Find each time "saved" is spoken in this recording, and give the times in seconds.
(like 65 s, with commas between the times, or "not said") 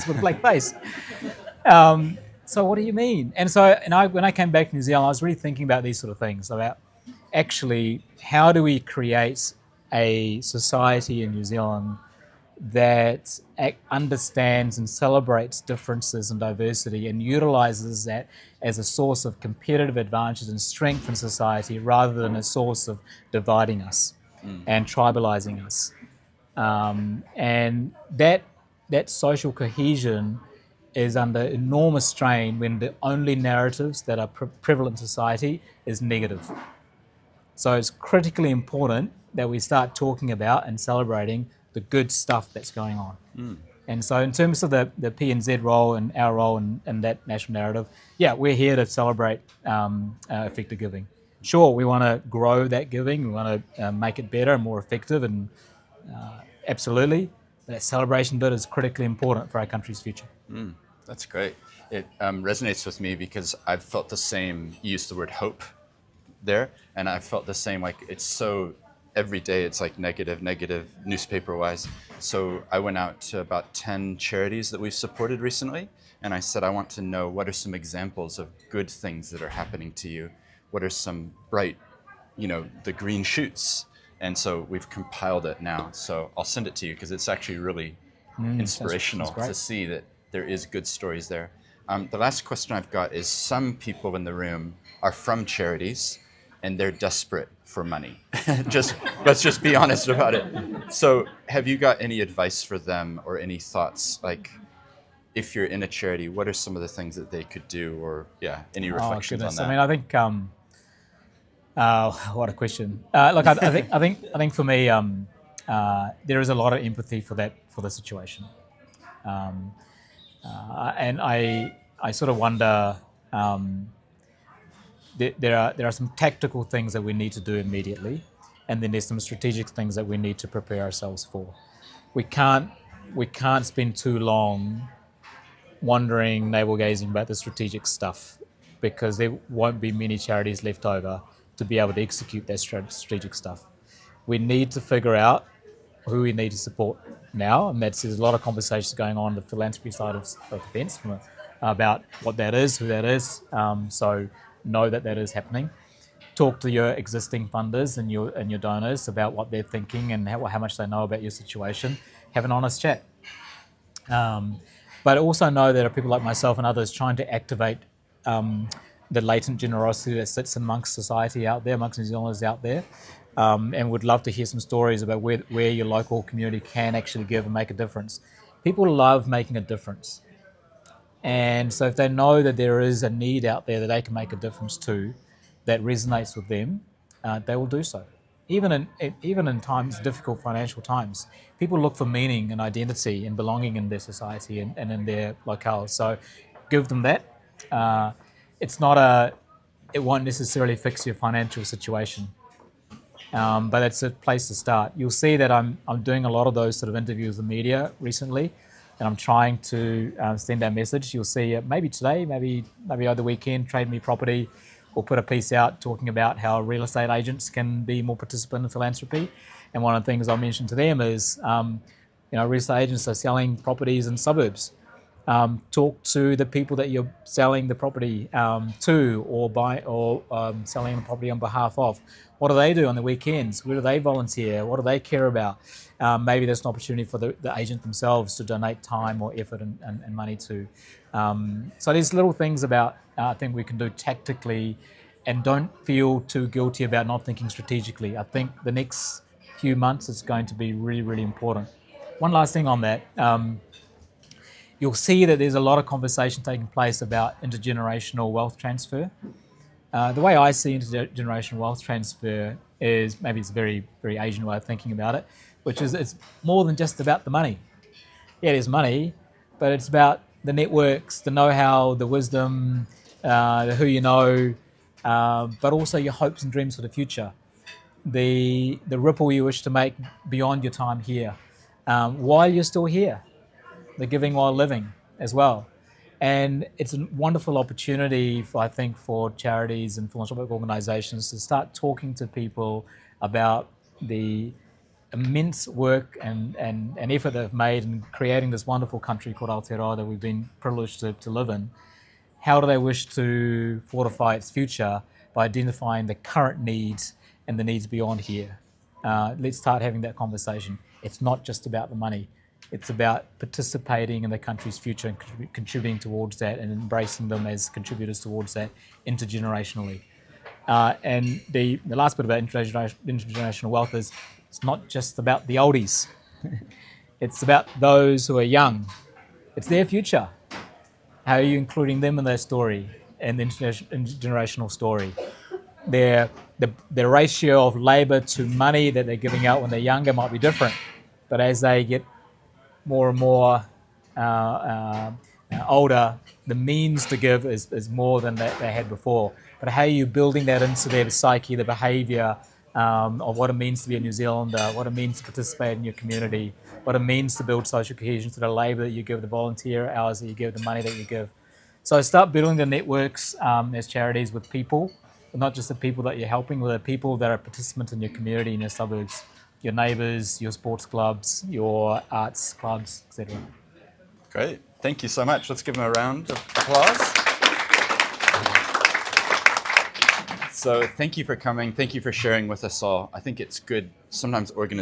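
not said.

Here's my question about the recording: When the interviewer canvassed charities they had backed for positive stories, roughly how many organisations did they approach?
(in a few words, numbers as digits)
10.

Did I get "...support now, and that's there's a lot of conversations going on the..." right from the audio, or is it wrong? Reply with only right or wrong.
right.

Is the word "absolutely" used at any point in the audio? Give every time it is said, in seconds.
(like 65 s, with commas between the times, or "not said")
56 s.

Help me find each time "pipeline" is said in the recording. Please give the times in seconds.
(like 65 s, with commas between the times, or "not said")
not said.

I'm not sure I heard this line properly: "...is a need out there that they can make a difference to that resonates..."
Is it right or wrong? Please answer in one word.
right.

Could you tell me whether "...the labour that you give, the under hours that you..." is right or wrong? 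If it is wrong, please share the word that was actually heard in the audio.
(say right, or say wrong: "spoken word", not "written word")
wrong: "volunteer", not "under".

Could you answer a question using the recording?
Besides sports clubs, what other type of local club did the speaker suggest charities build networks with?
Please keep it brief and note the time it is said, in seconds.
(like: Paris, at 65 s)
arts clubs, at 372 s.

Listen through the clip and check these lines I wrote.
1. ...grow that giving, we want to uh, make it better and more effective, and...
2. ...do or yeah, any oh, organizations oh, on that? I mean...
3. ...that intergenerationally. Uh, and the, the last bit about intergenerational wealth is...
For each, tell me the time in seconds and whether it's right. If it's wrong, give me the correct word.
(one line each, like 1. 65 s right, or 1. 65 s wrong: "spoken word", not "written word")
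1. 52 s right
2. 107 s wrong: "reflections", not "organizations"
3. 318 s right.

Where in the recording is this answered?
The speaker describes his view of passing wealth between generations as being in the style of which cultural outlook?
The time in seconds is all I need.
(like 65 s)
264 s.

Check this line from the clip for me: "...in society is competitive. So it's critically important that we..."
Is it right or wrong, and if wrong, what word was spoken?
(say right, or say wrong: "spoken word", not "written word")
wrong: "negative", not "competitive".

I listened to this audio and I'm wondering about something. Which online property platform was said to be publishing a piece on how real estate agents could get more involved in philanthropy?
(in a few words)
Trade Me Property.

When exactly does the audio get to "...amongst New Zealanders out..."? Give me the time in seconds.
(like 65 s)
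171 s.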